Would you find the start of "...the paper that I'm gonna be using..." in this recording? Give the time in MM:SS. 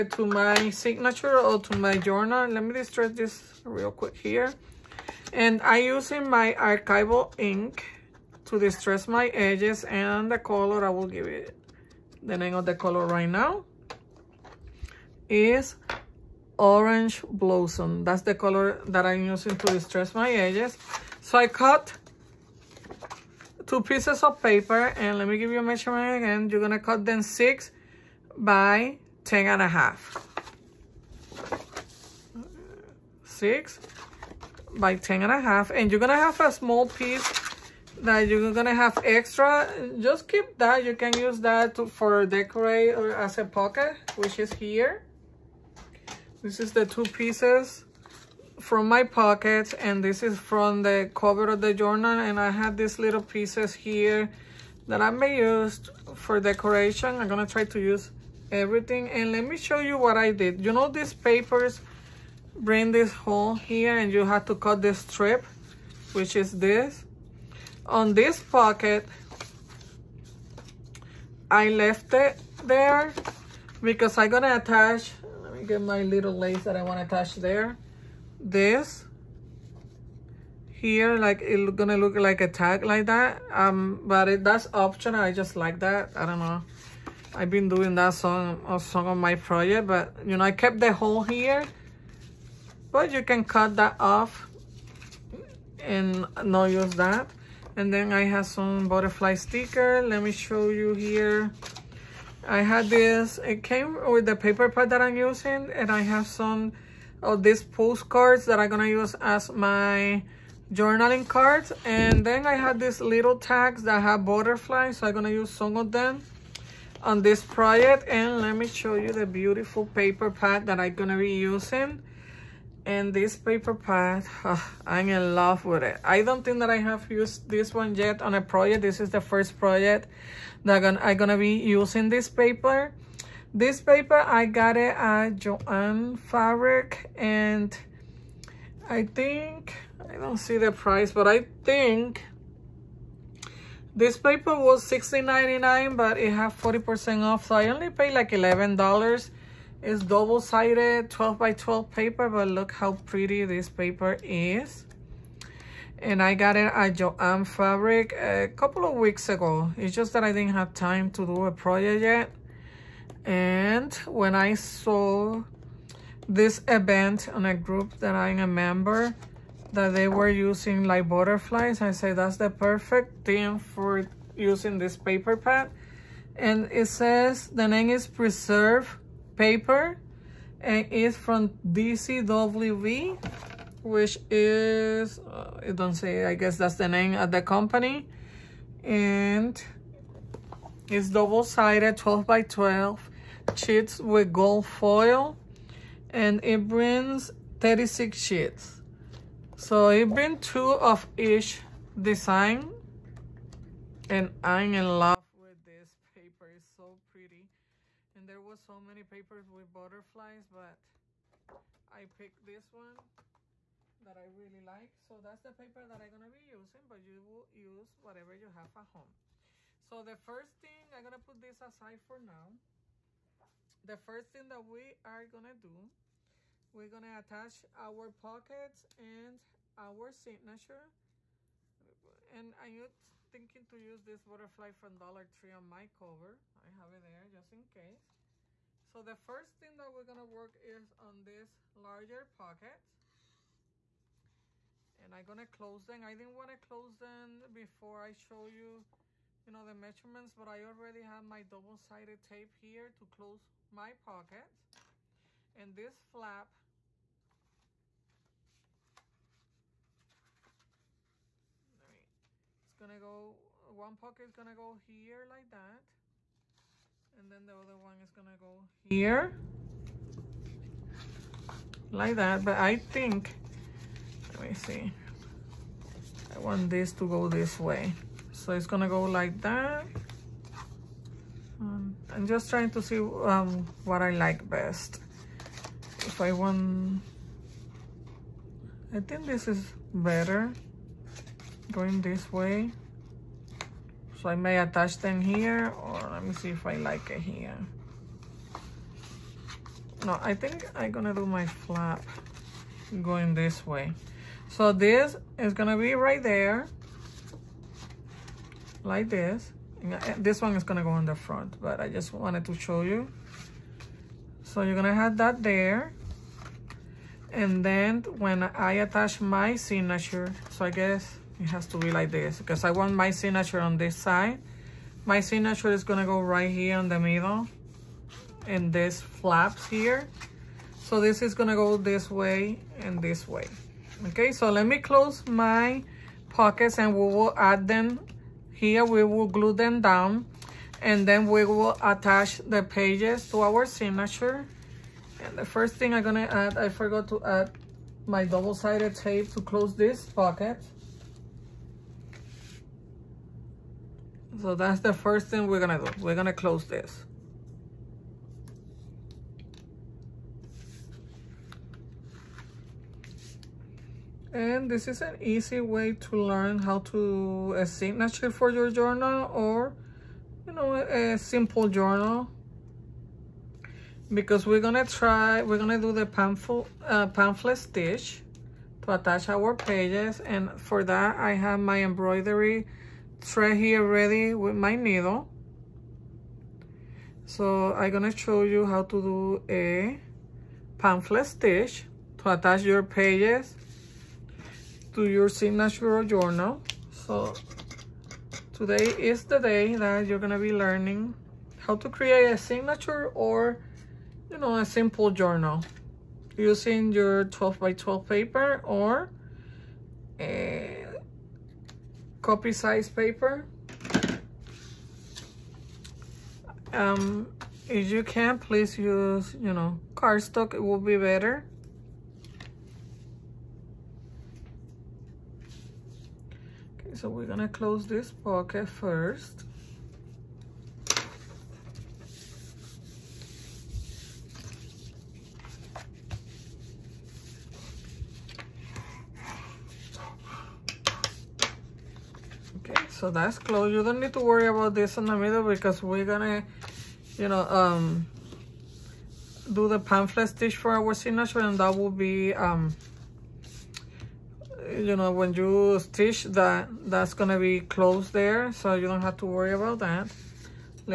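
03:35.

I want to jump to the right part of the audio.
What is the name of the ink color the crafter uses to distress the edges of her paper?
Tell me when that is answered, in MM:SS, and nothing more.
00:16.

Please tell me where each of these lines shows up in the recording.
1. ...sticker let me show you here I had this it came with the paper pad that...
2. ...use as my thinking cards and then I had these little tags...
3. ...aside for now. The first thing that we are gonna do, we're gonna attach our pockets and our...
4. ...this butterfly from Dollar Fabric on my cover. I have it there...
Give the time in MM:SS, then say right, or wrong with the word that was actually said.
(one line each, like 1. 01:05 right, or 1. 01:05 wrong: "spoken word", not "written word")
1. 01:39 right
2. 01:48 wrong: "journaling", not "thinking"
3. 03:41 right
4. 03:54 wrong: "Tree", not "Fabric".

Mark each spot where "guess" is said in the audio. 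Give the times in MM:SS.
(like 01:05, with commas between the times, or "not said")
03:06, 05:20.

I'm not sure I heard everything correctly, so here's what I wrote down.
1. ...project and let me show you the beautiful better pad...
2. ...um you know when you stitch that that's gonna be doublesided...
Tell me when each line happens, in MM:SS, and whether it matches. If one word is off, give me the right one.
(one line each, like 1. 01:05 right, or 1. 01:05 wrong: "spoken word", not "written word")
1. 01:57 wrong: "paper", not "better"
2. 07:32 wrong: "closed", not "doublesided".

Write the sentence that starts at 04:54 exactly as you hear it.
So I may attach them here or let me see if I like it here.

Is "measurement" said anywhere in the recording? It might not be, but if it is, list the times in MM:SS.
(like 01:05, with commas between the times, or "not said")
00:25, 04:09.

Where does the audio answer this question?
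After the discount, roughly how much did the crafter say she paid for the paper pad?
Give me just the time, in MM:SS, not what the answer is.
02:28.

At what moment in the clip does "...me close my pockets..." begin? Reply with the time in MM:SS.
05:34.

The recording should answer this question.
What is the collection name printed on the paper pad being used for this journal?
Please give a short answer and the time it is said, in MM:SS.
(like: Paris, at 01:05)
Preserve, at 02:58.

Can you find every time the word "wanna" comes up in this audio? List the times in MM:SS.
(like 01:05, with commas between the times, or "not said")
01:16, 04:06.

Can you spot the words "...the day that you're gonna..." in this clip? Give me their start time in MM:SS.
06:39.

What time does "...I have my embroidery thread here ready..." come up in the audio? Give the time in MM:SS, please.
06:21.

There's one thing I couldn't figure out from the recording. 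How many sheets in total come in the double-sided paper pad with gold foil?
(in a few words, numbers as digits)
36.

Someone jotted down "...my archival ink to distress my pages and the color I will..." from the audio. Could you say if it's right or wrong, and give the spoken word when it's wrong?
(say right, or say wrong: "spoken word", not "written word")
wrong: "edges", not "pages".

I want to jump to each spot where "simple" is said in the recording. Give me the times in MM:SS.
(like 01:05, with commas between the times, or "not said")
06:11, 06:44.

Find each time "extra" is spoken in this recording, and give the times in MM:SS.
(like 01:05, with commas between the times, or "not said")
00:39.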